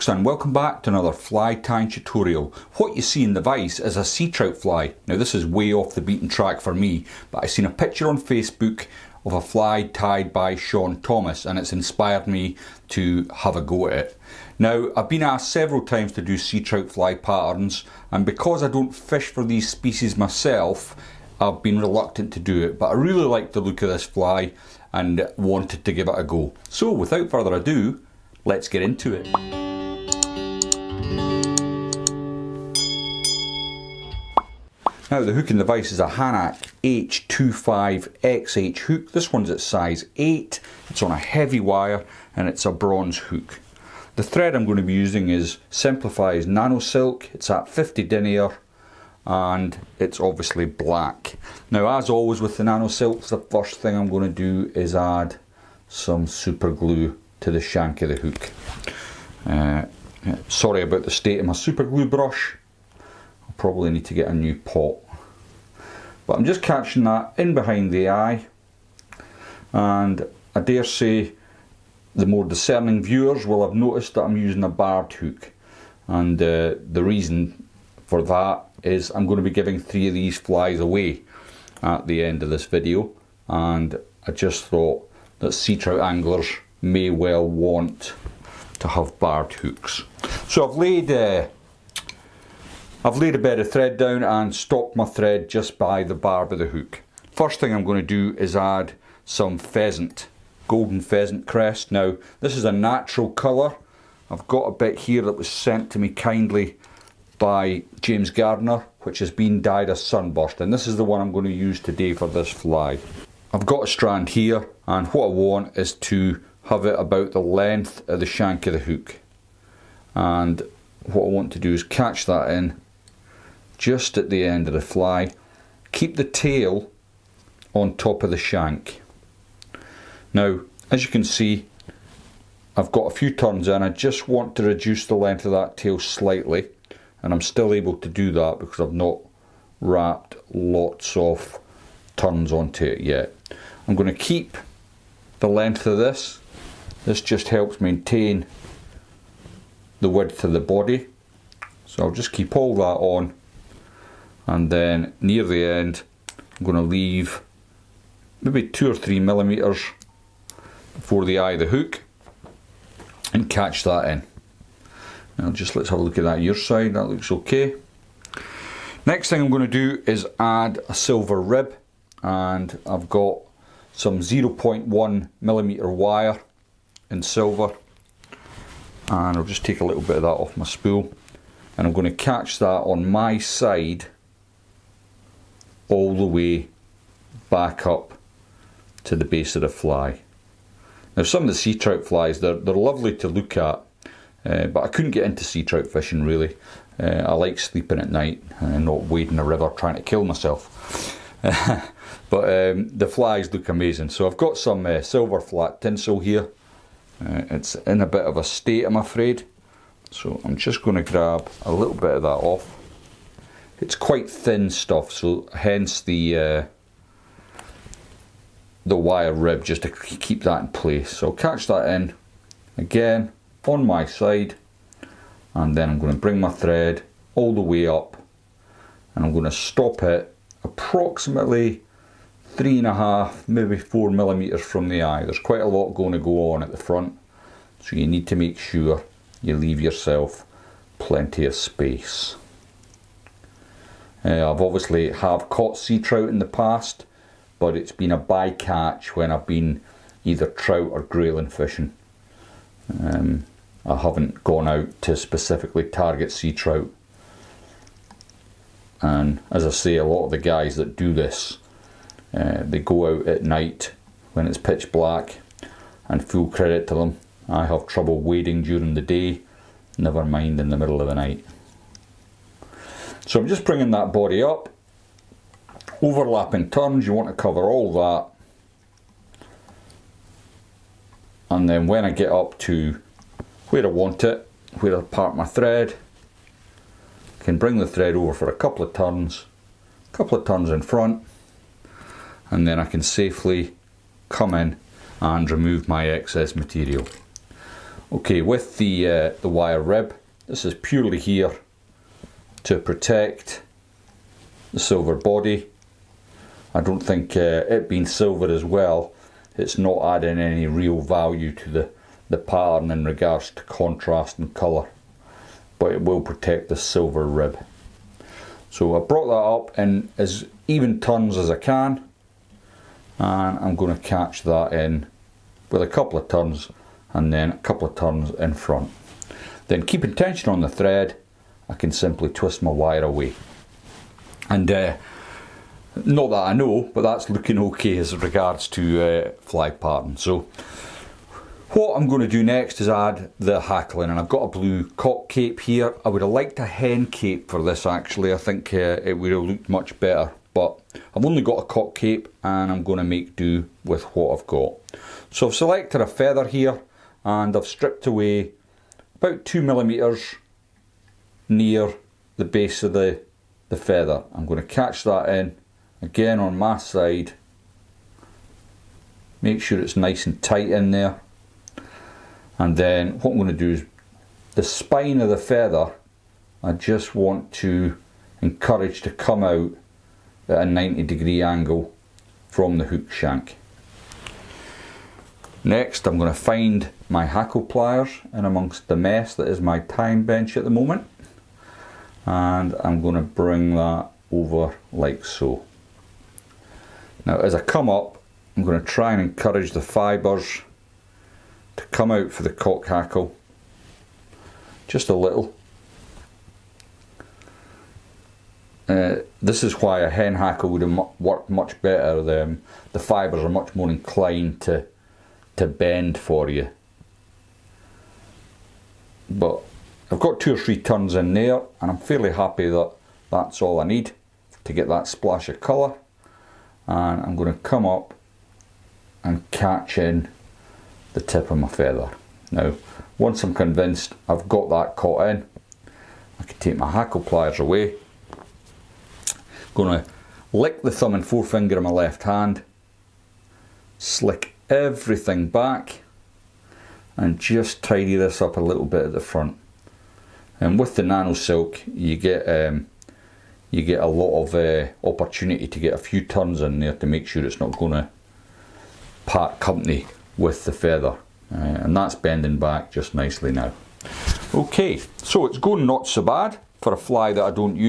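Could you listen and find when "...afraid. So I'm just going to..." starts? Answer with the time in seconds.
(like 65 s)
208 s.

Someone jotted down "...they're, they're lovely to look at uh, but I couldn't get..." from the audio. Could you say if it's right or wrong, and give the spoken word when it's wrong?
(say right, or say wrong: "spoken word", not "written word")
right.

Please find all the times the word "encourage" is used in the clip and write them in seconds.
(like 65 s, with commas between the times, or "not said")
378 s, 399 s.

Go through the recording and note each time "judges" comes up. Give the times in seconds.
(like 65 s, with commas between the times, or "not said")
not said.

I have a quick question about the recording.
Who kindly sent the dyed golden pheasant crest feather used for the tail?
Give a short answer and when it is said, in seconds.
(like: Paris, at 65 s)
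James Gardner, at 108 s.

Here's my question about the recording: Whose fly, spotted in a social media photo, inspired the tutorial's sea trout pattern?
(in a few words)
Sean Thomas.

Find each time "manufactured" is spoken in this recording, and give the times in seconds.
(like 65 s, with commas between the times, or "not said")
not said.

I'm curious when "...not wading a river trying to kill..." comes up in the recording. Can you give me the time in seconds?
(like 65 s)
198 s.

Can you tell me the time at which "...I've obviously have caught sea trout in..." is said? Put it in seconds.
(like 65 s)
244 s.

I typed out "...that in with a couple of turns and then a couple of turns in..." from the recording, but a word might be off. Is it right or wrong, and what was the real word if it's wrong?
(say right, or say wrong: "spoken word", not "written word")
right.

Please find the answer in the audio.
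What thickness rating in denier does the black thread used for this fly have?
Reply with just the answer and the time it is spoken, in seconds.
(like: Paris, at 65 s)
50, at 47 s.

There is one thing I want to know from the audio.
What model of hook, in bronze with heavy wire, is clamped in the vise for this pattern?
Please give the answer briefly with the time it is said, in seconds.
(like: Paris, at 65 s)
Hanak H25XH, at 36 s.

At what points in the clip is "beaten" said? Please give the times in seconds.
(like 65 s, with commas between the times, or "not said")
6 s.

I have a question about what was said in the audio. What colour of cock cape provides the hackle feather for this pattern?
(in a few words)
Blue.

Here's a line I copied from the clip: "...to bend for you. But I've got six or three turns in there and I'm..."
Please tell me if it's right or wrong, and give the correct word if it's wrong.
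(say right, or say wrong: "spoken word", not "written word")
wrong: "two", not "six".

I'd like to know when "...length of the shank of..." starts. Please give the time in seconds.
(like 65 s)
117 s.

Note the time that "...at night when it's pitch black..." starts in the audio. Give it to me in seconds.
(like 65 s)
263 s.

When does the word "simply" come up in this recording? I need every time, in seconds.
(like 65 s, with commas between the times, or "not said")
331 s.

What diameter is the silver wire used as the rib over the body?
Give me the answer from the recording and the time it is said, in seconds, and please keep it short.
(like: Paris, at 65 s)
0.1 millimeter, at 174 s.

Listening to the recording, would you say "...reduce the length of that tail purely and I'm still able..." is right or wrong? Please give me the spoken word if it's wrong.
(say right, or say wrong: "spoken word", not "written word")
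wrong: "slightly", not "purely".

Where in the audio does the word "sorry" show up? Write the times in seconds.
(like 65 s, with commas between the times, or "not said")
60 s.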